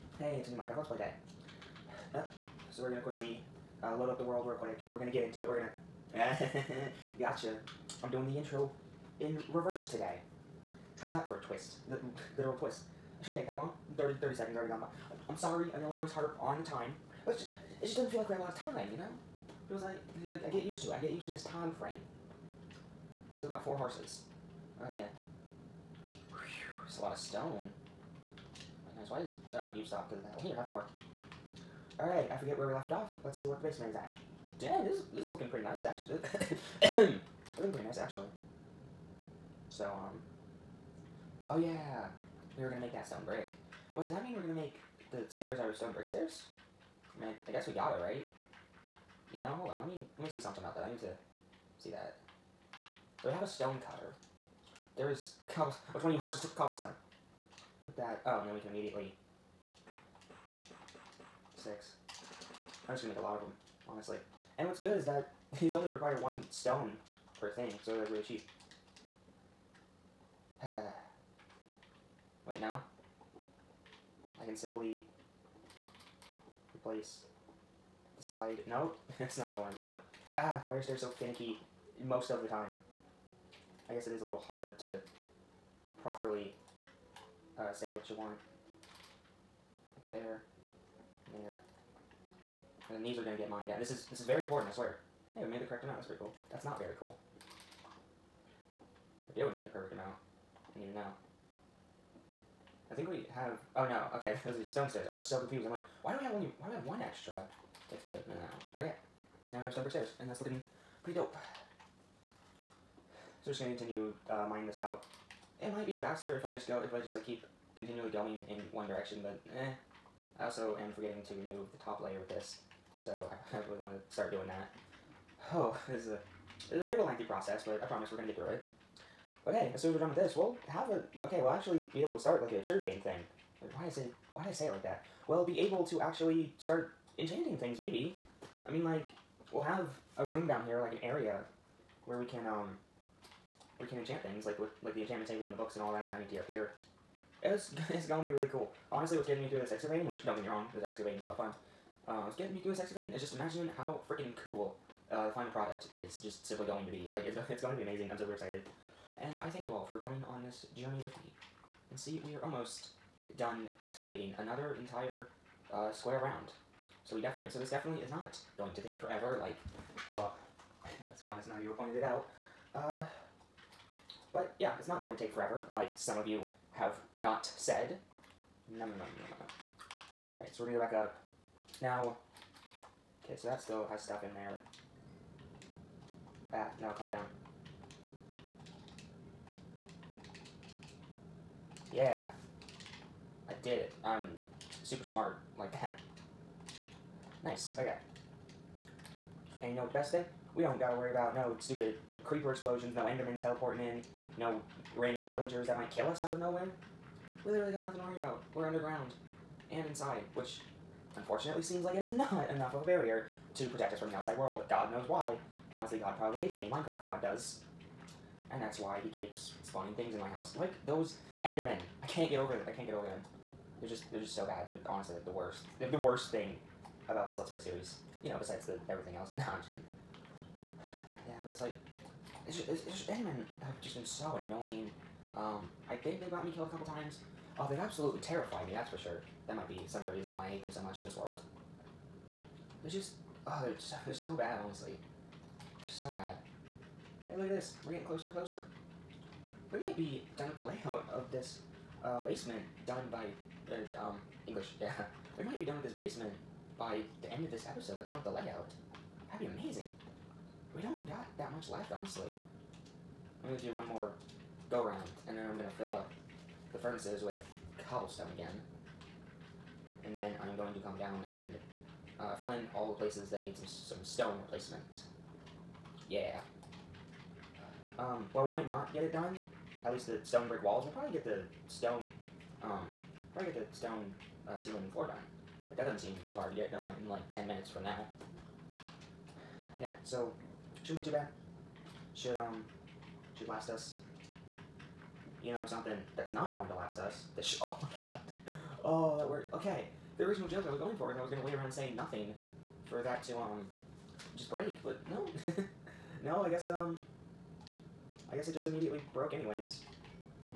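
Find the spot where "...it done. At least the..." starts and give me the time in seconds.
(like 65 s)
279 s.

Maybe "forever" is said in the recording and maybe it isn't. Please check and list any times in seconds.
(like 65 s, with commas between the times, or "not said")
168 s, 175 s.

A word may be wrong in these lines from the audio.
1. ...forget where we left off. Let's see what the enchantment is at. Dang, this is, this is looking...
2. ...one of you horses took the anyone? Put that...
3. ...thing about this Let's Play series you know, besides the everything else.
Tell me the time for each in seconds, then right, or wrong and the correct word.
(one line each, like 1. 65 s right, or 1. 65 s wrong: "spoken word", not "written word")
1. 32 s wrong: "basement", not "enchantment"
2. 56 s wrong: "cobblestone", not "anyone"
3. 226 s right.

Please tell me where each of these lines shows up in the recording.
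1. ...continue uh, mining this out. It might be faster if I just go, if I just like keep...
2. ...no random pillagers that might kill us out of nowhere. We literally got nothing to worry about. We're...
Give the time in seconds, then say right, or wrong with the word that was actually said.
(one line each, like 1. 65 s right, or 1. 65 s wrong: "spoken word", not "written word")
1. 113 s right
2. 204 s right.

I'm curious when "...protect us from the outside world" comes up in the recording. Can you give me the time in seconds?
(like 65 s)
213 s.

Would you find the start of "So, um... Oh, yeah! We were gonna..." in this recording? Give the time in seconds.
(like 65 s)
39 s.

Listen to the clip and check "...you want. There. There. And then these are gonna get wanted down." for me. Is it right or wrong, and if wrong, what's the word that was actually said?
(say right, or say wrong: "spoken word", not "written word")
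wrong: "mined", not "wanted".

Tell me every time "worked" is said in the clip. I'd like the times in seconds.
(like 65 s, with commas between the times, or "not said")
299 s.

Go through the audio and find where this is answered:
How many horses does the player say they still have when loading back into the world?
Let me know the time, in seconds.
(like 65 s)
23 s.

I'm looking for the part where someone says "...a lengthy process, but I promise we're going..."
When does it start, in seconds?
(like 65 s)
126 s.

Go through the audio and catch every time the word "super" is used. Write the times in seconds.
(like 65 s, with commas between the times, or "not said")
158 s, 194 s.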